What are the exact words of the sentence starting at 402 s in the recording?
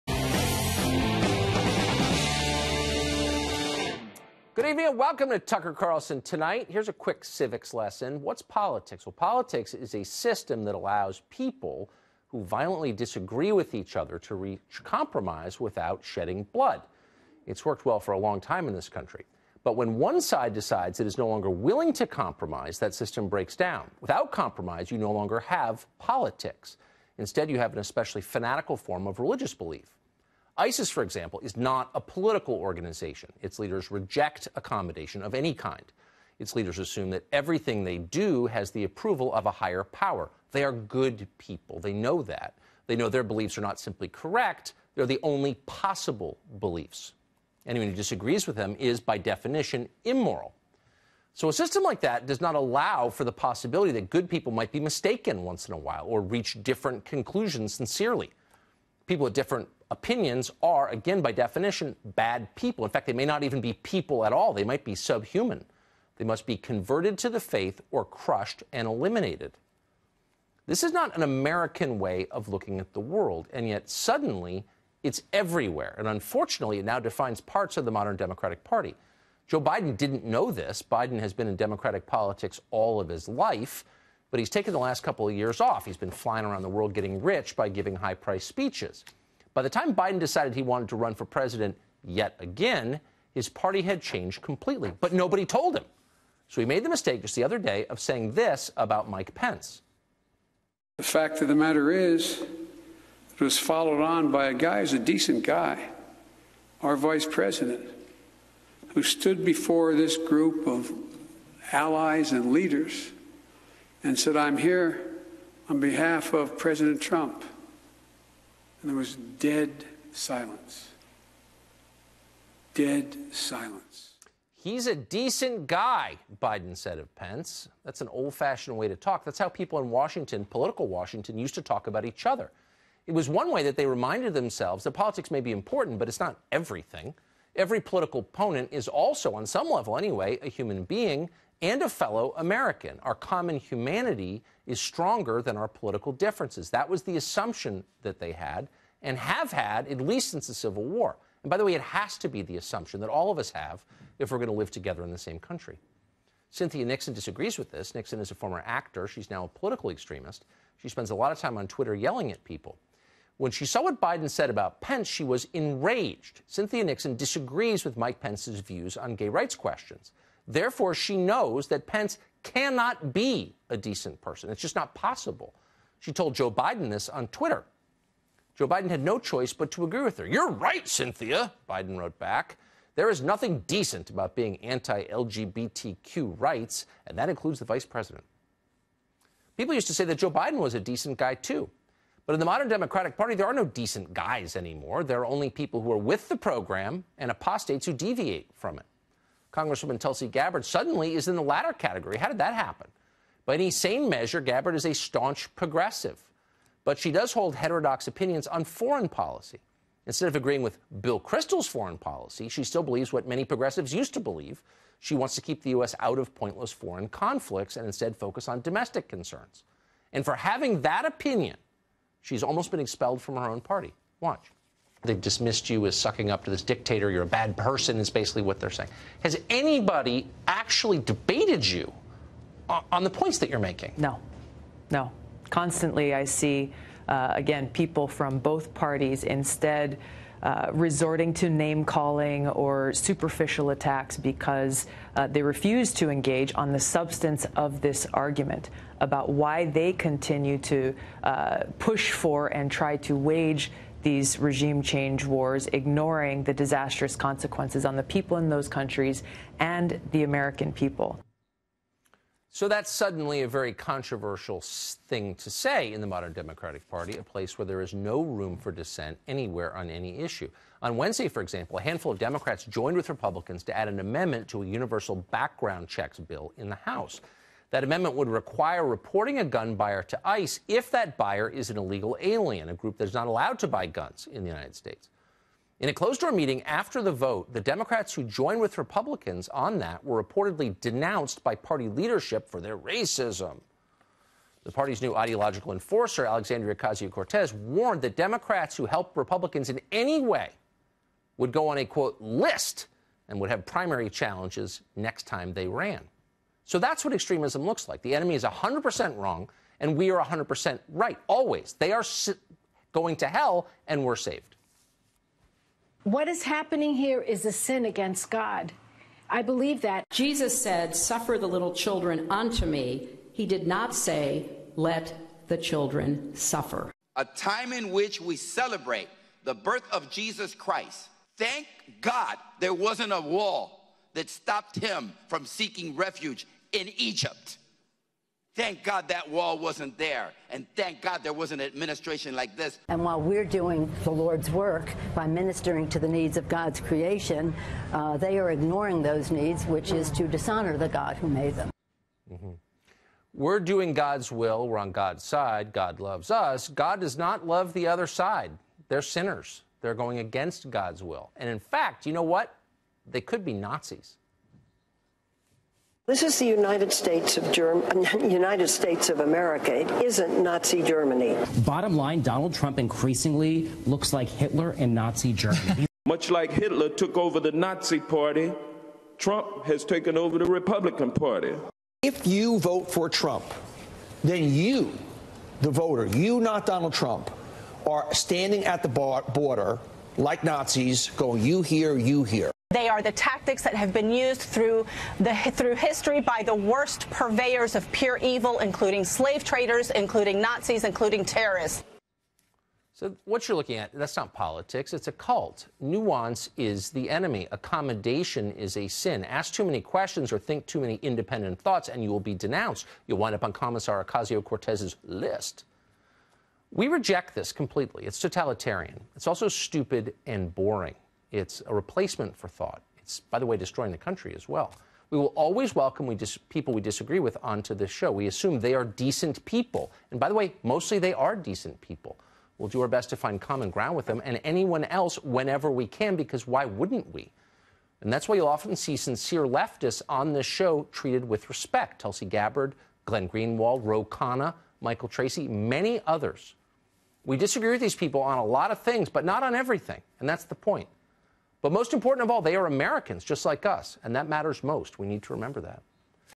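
So what you're looking at, that's not politics, it's a cult.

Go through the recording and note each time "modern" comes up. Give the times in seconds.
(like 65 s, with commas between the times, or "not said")
77 s, 192 s, 266 s.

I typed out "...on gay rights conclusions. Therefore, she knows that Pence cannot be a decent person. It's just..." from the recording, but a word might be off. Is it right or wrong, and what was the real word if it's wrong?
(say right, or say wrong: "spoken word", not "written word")
wrong: "questions", not "conclusions".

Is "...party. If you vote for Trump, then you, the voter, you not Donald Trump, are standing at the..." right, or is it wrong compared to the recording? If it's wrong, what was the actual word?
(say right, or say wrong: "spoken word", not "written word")
right.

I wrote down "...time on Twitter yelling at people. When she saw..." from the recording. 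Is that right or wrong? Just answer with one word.
right.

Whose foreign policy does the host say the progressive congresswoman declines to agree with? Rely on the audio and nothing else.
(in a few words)
Bill Kristol.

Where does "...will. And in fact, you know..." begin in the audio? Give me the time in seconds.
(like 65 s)
361 s.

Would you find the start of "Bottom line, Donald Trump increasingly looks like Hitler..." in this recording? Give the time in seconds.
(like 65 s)
371 s.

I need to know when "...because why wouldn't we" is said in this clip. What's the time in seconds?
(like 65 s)
436 s.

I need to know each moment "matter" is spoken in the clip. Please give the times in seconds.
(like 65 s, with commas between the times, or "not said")
101 s, 454 s.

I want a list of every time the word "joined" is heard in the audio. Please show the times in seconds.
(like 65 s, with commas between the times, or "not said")
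272 s, 288 s.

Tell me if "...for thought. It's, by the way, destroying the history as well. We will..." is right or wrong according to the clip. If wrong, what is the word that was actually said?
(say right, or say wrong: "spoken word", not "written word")
wrong: "country", not "history".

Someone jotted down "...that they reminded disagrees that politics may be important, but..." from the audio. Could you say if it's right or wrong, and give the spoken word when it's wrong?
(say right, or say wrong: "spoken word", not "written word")
wrong: "themselves", not "disagrees".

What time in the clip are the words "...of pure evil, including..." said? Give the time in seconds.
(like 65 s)
397 s.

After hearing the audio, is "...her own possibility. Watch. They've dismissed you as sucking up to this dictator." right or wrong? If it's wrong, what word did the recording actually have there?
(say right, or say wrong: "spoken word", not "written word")
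wrong: "party", not "possibility".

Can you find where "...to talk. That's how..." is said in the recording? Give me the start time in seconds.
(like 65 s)
128 s.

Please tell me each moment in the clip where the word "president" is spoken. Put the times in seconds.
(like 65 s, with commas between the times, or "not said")
91 s, 107 s, 116 s, 187 s.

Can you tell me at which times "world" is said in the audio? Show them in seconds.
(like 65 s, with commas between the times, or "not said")
73 s, 86 s.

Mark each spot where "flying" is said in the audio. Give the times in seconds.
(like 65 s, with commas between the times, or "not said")
86 s.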